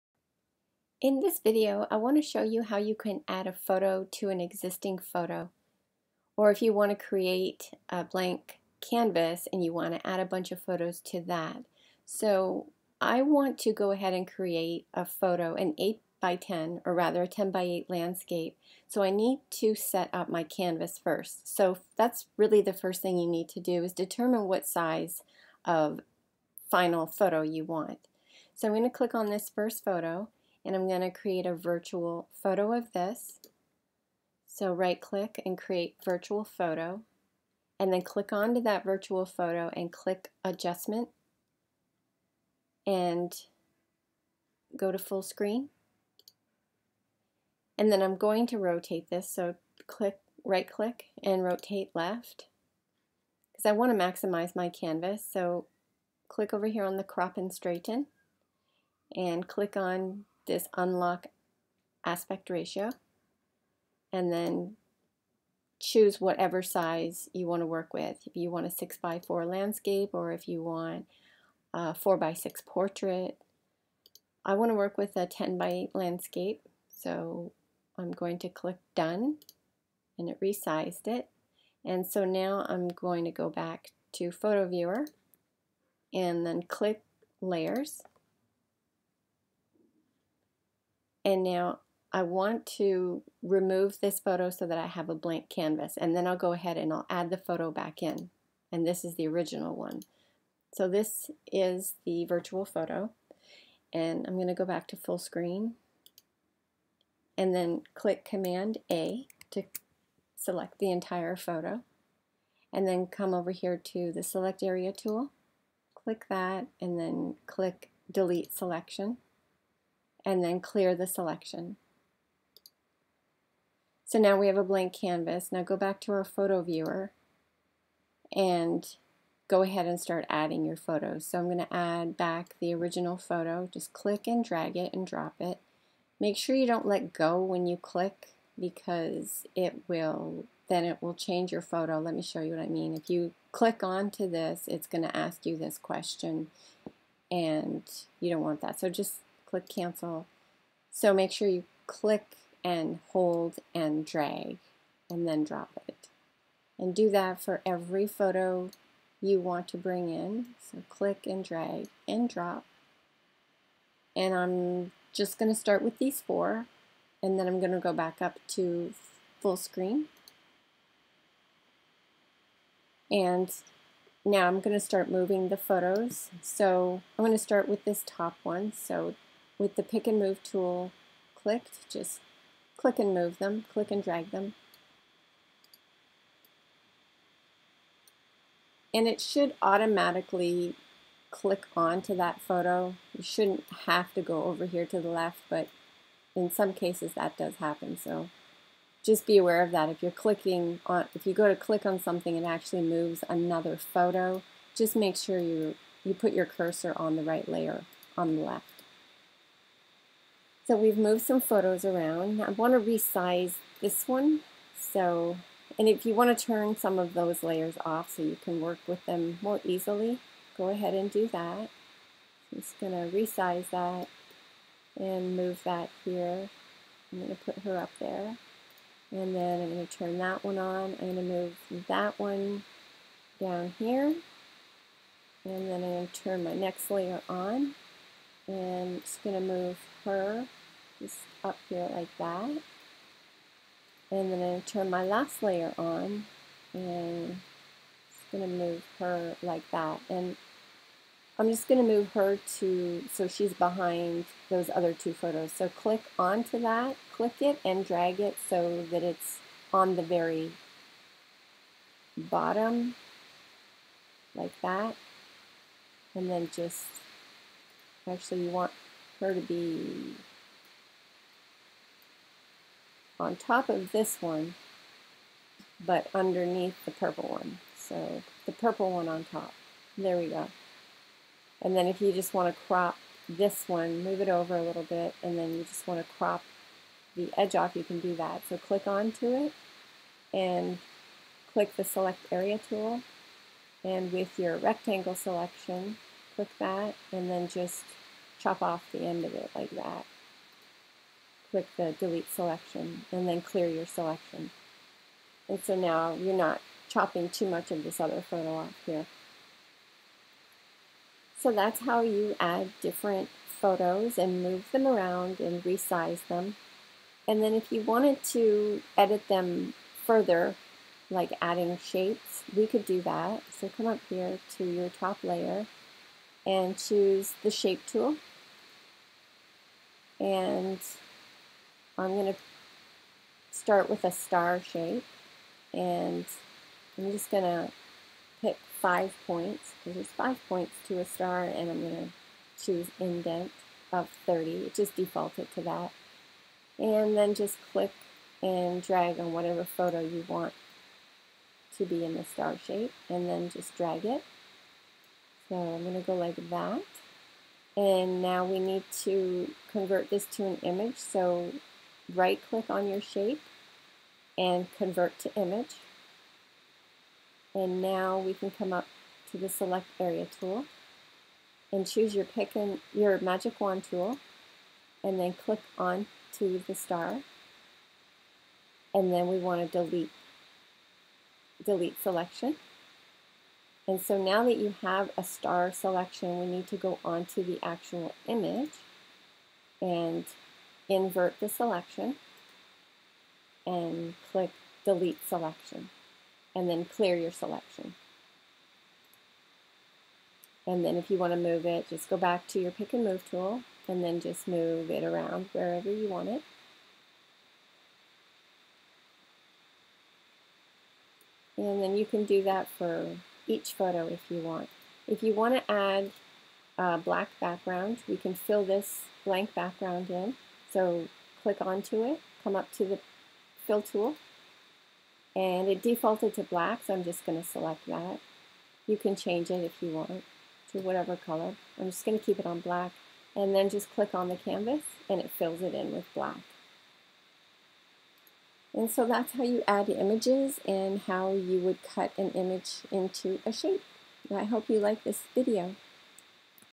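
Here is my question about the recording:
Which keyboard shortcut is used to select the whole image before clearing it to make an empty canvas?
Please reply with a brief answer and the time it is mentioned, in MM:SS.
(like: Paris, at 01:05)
Command A, at 01:48.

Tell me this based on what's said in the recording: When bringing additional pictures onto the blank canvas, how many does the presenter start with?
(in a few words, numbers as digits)
4.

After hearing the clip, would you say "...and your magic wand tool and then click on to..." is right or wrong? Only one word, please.
right.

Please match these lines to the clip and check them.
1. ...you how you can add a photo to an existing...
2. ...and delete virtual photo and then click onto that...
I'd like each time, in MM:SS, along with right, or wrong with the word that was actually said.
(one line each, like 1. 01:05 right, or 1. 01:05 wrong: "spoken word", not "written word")
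1. 00:02 right
2. 00:35 wrong: "create", not "delete".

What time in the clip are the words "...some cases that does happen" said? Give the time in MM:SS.
03:16.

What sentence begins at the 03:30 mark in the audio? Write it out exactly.
So we've moved some photos around.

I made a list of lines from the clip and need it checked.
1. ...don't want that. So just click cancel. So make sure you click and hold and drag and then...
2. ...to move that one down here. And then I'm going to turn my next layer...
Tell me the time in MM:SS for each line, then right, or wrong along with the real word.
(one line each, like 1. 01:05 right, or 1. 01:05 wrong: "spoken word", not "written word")
1. 02:28 right
2. 03:51 right.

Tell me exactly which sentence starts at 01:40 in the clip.
So this is the virtual photo.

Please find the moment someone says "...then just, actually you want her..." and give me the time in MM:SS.
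04:26.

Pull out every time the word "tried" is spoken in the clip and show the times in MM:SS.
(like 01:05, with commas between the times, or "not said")
not said.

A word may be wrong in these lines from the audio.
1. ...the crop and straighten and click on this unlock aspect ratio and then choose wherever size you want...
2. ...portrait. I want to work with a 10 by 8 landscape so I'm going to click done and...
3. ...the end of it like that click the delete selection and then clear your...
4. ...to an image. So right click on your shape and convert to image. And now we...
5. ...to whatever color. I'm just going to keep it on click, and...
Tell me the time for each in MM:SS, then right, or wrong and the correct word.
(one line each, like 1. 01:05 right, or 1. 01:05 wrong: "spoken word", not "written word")
1. 00:56 wrong: "whatever", not "wherever"
2. 01:12 right
3. 04:58 right
4. 06:00 right
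5. 07:10 wrong: "black", not "click".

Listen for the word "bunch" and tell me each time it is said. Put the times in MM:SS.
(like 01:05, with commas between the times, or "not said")
00:10.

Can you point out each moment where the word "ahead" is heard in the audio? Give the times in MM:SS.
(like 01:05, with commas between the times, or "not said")
00:13, 01:36, 02:09, 03:40.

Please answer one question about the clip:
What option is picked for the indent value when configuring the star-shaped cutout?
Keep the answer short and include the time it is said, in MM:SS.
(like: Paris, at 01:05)
30, at 05:44.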